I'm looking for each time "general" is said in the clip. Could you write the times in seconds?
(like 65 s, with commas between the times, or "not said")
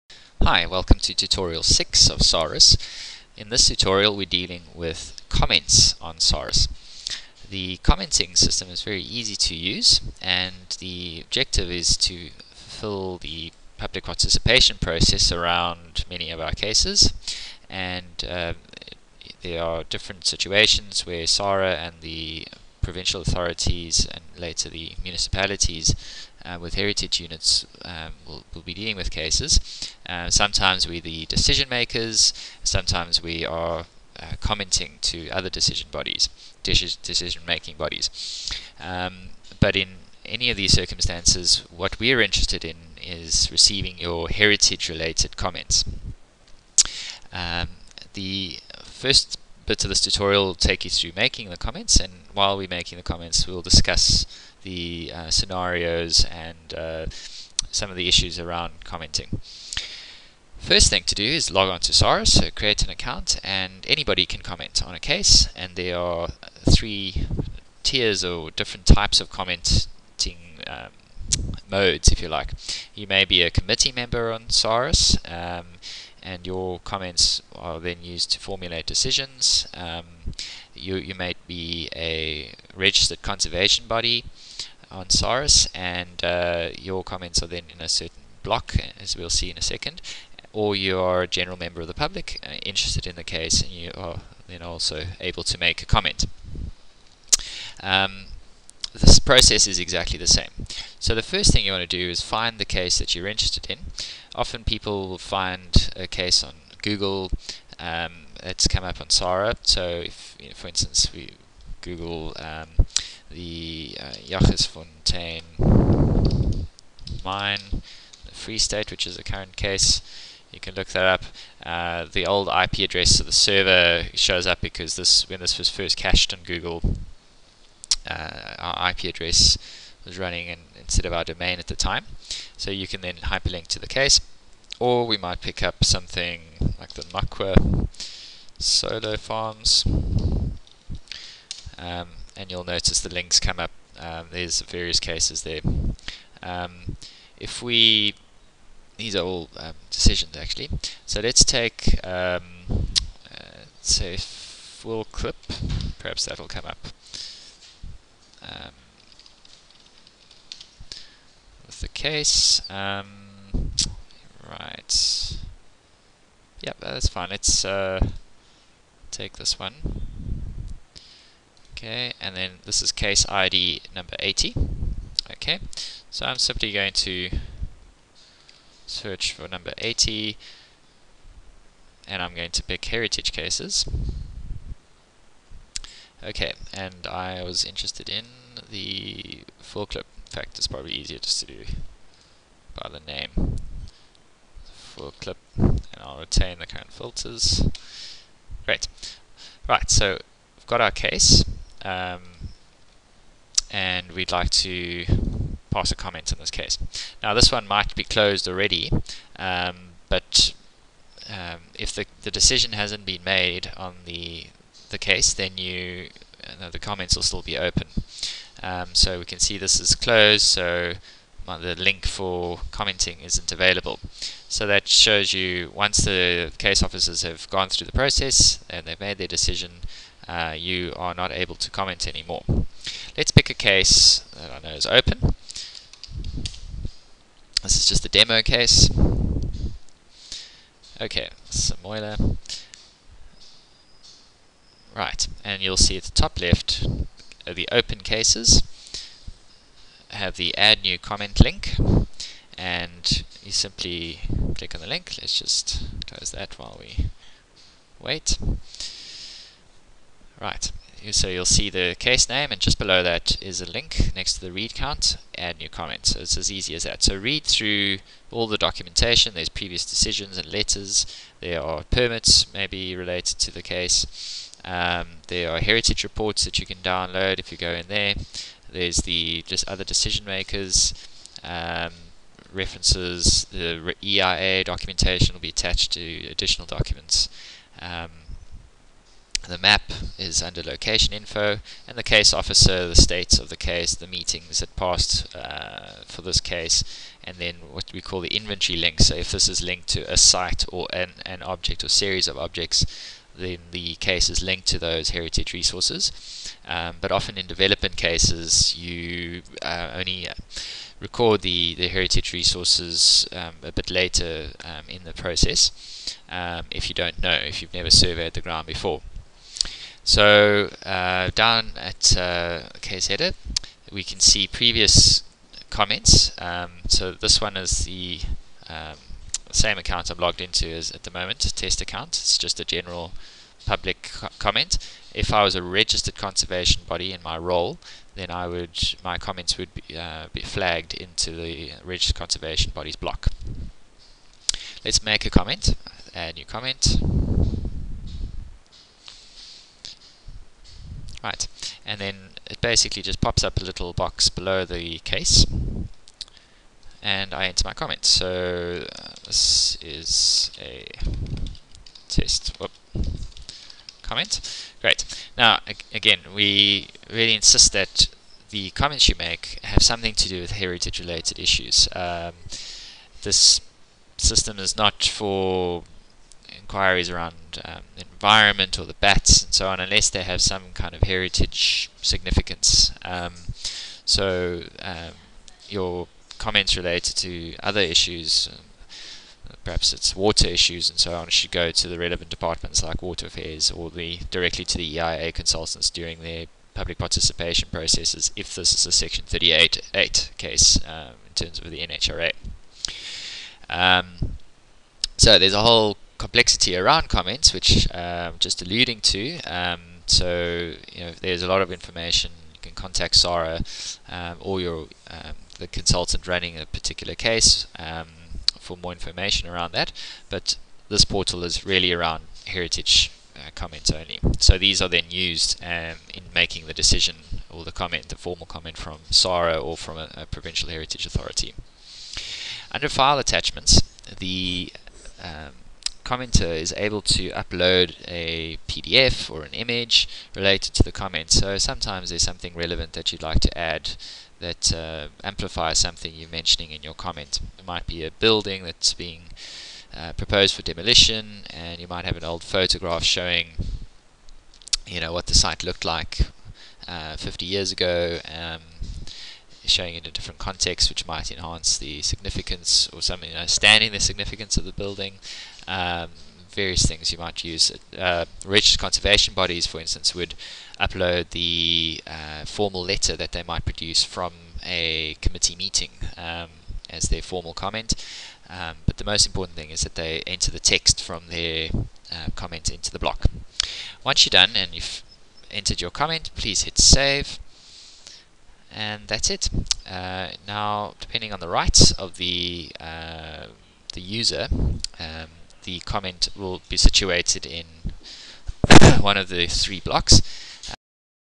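91 s, 332 s.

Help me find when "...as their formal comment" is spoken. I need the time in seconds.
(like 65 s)
476 s.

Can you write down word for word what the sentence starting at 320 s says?
So uh, down at uh, case header, we can see previous comments.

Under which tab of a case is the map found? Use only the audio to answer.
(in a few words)
Location info.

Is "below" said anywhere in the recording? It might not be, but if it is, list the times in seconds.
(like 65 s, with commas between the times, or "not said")
262 s, 354 s.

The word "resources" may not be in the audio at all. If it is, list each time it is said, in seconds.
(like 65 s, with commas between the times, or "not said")
305 s, 312 s.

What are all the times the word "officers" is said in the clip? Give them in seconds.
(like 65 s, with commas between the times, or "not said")
226 s, 292 s.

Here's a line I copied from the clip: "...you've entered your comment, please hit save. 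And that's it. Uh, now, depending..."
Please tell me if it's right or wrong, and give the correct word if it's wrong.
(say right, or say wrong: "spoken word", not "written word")
right.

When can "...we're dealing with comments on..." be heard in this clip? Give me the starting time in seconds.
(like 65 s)
4 s.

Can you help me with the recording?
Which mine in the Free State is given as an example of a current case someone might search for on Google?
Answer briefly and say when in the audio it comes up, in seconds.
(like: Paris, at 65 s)
Jagersfontein mine, at 114 s.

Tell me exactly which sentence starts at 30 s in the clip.
Uh, sometimes we're the decision makers, sometimes we are uh, commenting to other decision bodies, decision making bodies.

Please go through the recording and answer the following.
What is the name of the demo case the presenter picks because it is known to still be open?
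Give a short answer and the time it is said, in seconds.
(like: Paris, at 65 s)
Samoyla, at 241 s.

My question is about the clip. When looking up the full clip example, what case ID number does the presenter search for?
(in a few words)
80.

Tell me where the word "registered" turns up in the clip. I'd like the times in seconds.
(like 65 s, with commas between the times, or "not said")
82 s, 335 s, 341 s, 468 s.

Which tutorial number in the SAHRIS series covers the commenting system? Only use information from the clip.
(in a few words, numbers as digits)
6.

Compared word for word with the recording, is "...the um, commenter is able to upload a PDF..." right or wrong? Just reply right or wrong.
right.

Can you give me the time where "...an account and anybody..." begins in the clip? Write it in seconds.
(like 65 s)
62 s.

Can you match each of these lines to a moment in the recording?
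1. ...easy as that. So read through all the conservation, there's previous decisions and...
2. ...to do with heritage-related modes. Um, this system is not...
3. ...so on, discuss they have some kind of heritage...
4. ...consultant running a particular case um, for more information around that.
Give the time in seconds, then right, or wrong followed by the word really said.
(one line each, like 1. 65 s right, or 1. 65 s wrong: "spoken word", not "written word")
1. 266 s wrong: "documentation", not "conservation"
2. 370 s wrong: "issues", not "modes"
3. 379 s wrong: "unless", not "discuss"
4. 415 s right.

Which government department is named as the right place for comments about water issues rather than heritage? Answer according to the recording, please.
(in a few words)
Water Affairs.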